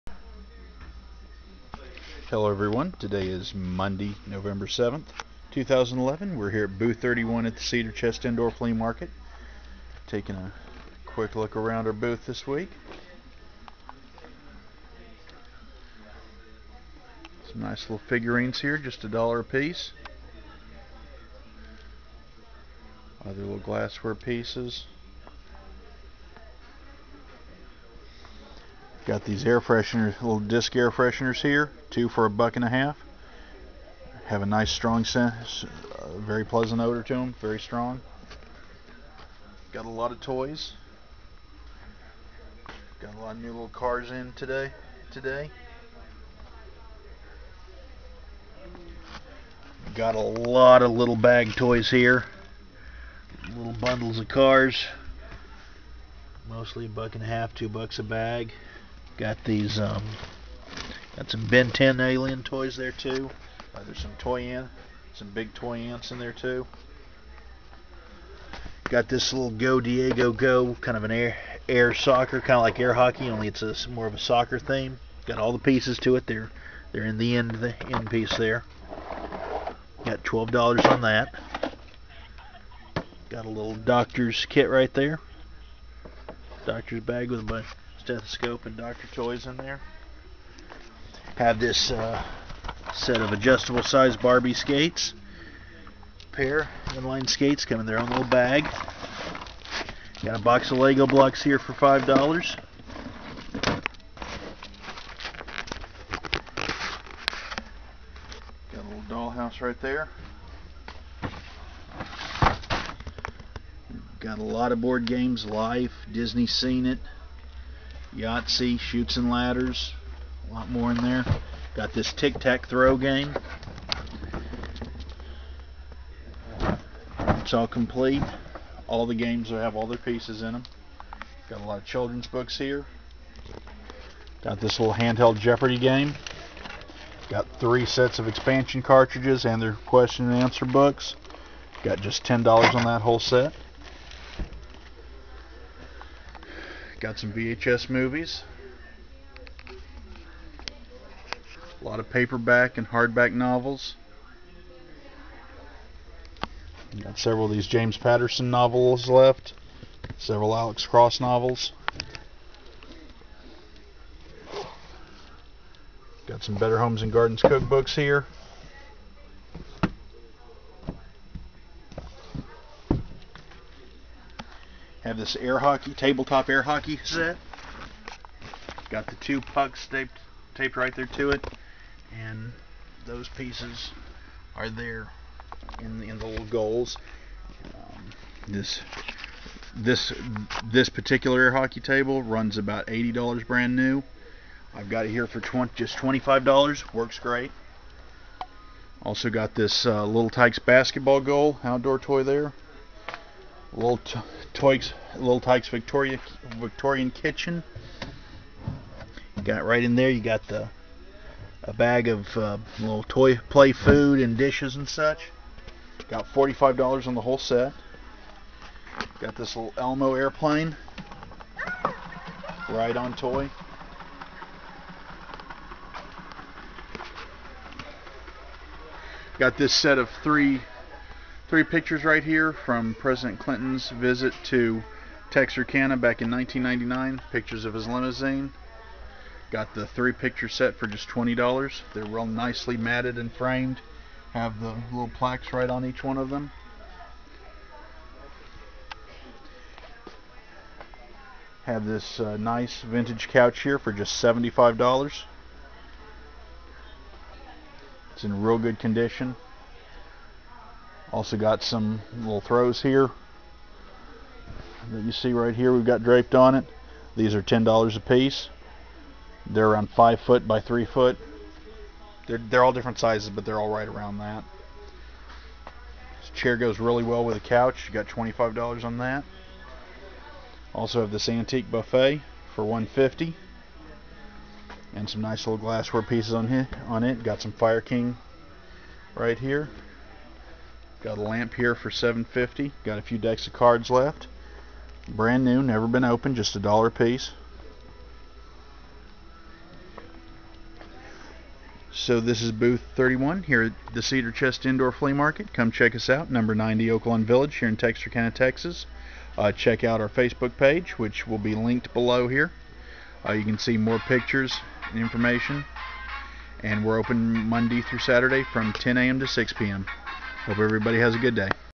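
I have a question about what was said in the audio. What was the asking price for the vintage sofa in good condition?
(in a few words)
$75.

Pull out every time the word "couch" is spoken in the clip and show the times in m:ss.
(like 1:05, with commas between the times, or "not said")
4:13, 4:37.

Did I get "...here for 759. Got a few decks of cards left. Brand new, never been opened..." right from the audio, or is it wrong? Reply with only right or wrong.
wrong.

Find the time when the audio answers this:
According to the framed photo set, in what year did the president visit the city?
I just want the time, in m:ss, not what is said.
3:56.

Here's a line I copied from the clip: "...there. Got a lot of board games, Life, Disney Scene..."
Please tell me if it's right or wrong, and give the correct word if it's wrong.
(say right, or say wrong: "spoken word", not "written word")
right.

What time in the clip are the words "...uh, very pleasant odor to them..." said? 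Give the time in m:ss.
0:35.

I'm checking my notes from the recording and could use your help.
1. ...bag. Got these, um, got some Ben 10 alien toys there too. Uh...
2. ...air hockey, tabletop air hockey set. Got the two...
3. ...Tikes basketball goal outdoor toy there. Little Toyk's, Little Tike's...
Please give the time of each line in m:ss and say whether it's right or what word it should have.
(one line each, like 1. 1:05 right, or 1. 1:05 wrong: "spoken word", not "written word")
1. 0:58 right
2. 2:55 right
3. 3:20 right.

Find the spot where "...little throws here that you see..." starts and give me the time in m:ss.
4:22.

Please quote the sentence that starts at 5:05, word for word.
Come check us out, number 90 Oaklawn Village here in Texarkana, Texas.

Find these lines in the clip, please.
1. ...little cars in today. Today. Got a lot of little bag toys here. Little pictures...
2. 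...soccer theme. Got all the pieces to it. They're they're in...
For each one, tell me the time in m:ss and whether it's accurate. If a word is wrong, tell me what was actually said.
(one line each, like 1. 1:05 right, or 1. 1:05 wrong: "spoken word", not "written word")
1. 0:43 wrong: "bundles", not "pictures"
2. 1:14 right.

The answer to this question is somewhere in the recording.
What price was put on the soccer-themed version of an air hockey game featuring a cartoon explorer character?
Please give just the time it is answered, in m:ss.
1:20.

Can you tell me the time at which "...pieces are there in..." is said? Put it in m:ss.
3:03.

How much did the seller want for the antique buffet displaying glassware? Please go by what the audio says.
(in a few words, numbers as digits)
$150.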